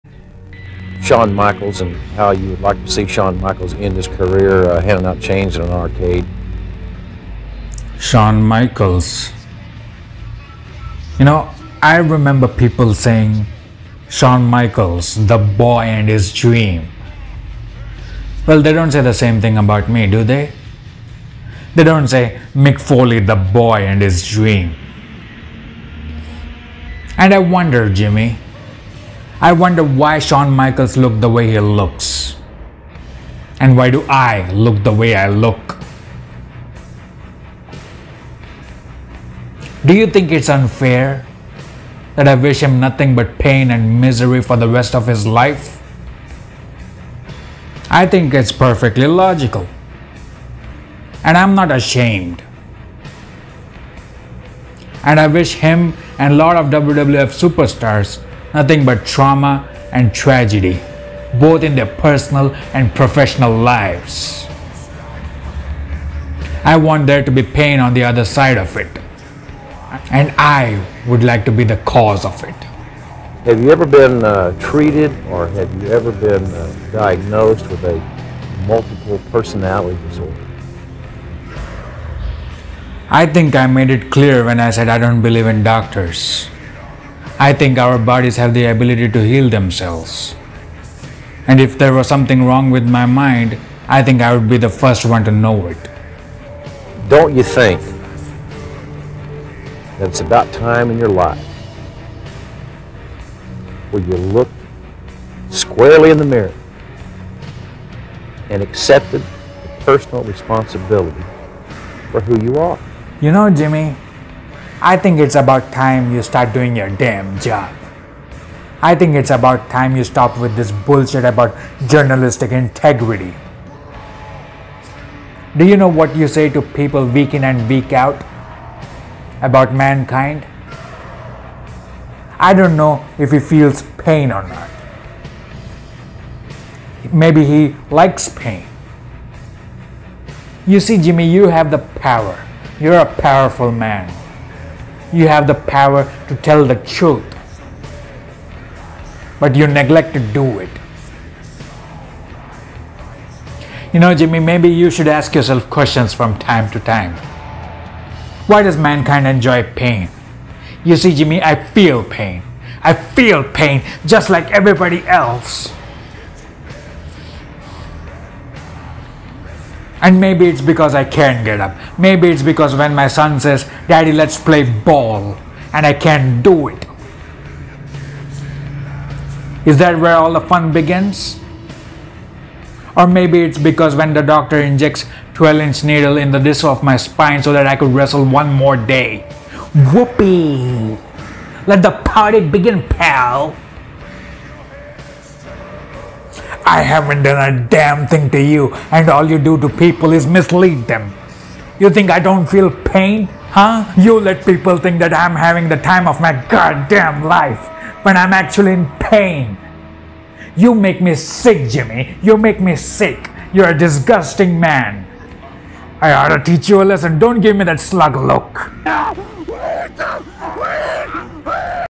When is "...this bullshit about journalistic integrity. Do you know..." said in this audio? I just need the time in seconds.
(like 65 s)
120 s.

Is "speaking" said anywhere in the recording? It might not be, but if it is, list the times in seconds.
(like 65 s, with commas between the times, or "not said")
not said.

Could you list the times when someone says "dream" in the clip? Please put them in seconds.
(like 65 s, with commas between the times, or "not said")
16 s, 24 s.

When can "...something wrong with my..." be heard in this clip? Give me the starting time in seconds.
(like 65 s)
92 s.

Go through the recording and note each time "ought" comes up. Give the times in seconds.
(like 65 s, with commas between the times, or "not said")
216 s.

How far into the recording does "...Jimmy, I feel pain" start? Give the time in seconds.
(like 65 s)
161 s.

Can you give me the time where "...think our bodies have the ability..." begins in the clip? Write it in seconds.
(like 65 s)
87 s.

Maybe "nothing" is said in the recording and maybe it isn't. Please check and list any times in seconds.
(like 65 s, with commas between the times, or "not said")
42 s, 58 s.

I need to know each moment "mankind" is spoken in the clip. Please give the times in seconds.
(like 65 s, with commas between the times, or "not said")
129 s, 158 s.